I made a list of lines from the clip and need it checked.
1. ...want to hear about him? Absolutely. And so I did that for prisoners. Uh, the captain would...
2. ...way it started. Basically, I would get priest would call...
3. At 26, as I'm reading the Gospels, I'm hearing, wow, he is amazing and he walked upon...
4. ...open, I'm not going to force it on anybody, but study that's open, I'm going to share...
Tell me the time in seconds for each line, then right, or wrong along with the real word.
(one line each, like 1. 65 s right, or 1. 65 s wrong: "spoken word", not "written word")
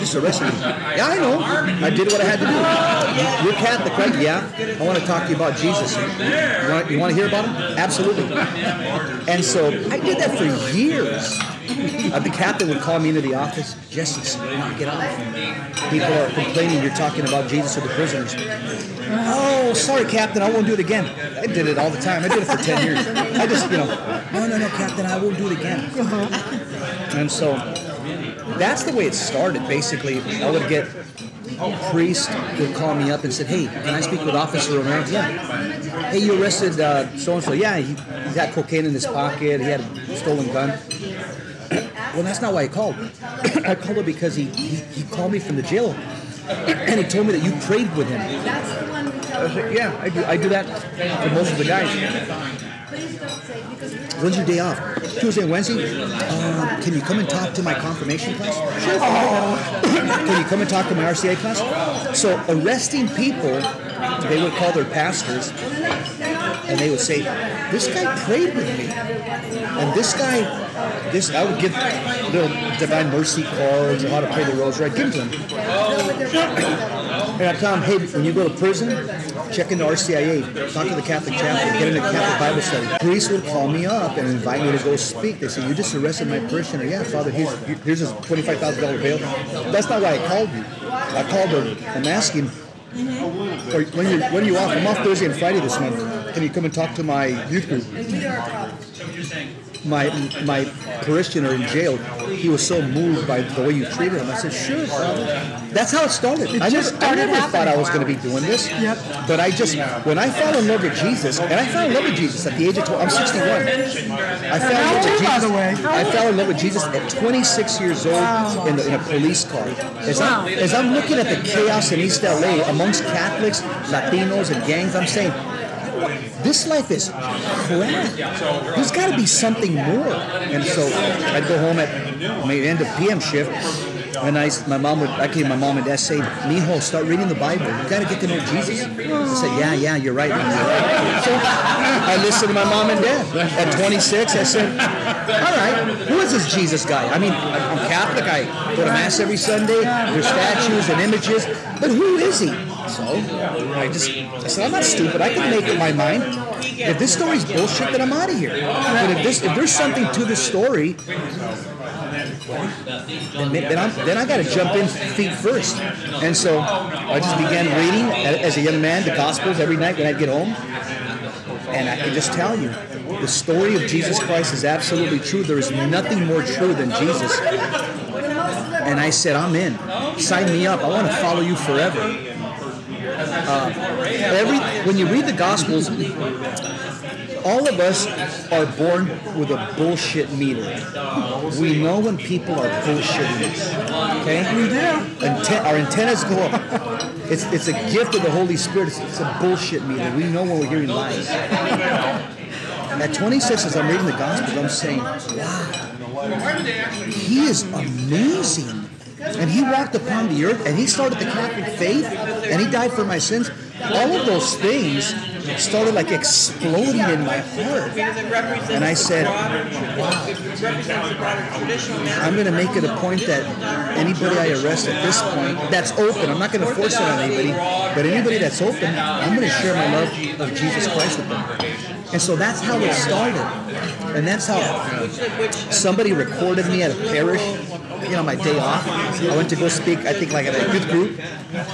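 1. 6 s wrong: "years", not "prisoners"
2. 28 s right
3. 201 s wrong: "saying", not "hearing"
4. 225 s wrong: "anybody", not "study".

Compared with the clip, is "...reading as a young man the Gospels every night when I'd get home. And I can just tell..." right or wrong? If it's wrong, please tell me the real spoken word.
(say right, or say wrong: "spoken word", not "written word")
right.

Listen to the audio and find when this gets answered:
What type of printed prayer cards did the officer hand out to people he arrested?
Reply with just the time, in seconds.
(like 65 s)
72 s.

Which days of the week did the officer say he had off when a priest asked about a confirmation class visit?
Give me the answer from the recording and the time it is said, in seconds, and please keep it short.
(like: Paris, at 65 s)
Tuesday and Wednesday, at 55 s.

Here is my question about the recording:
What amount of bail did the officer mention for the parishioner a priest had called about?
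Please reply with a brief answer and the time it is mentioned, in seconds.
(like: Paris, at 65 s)
$25,000, at 88 s.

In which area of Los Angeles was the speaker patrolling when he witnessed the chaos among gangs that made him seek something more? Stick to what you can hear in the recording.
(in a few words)
East LA.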